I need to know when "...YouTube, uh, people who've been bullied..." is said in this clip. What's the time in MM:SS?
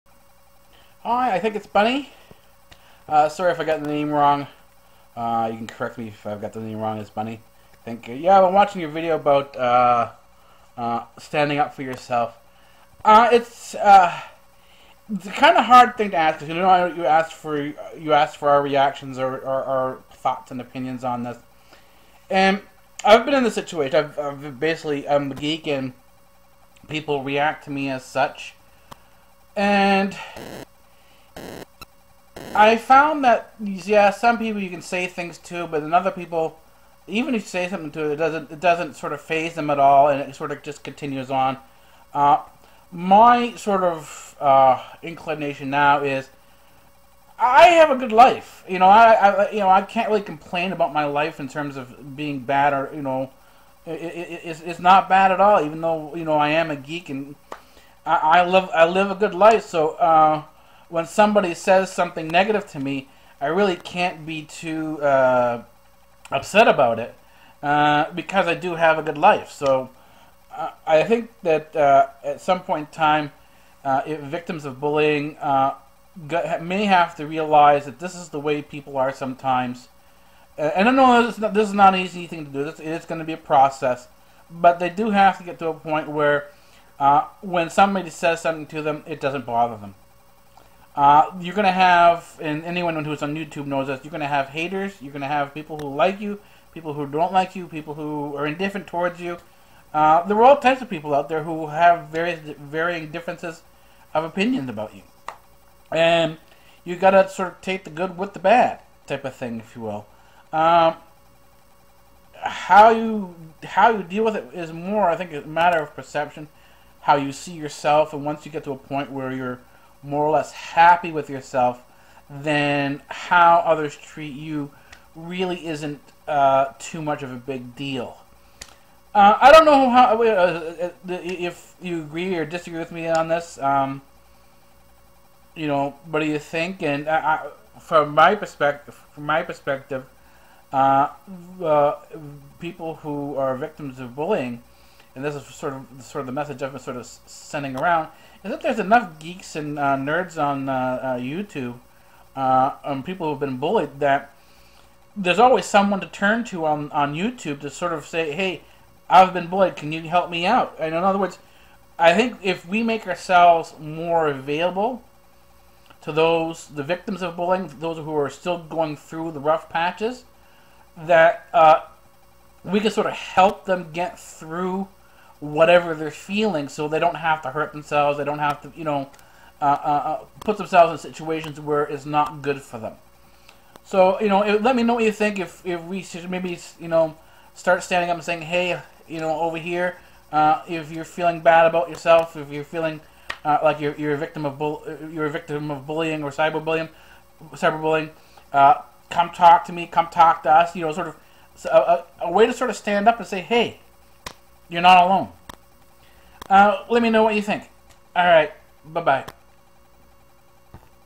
02:31.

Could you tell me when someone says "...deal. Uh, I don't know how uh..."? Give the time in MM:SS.
02:07.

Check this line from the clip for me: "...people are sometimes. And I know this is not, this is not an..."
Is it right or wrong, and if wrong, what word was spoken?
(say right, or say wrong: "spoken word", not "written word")
right.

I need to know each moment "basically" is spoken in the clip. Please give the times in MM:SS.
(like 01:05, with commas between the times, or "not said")
00:24.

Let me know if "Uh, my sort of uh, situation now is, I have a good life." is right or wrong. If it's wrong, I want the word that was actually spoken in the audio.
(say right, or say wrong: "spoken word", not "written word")
wrong: "inclination", not "situation".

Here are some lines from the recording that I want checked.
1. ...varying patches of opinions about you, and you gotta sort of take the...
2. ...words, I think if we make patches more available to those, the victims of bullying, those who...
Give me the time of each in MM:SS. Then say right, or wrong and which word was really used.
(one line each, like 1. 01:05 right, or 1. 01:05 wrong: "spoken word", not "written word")
1. 01:42 wrong: "differences", not "patches"
2. 02:41 wrong: "ourselves", not "patches".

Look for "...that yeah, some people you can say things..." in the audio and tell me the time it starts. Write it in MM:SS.
00:33.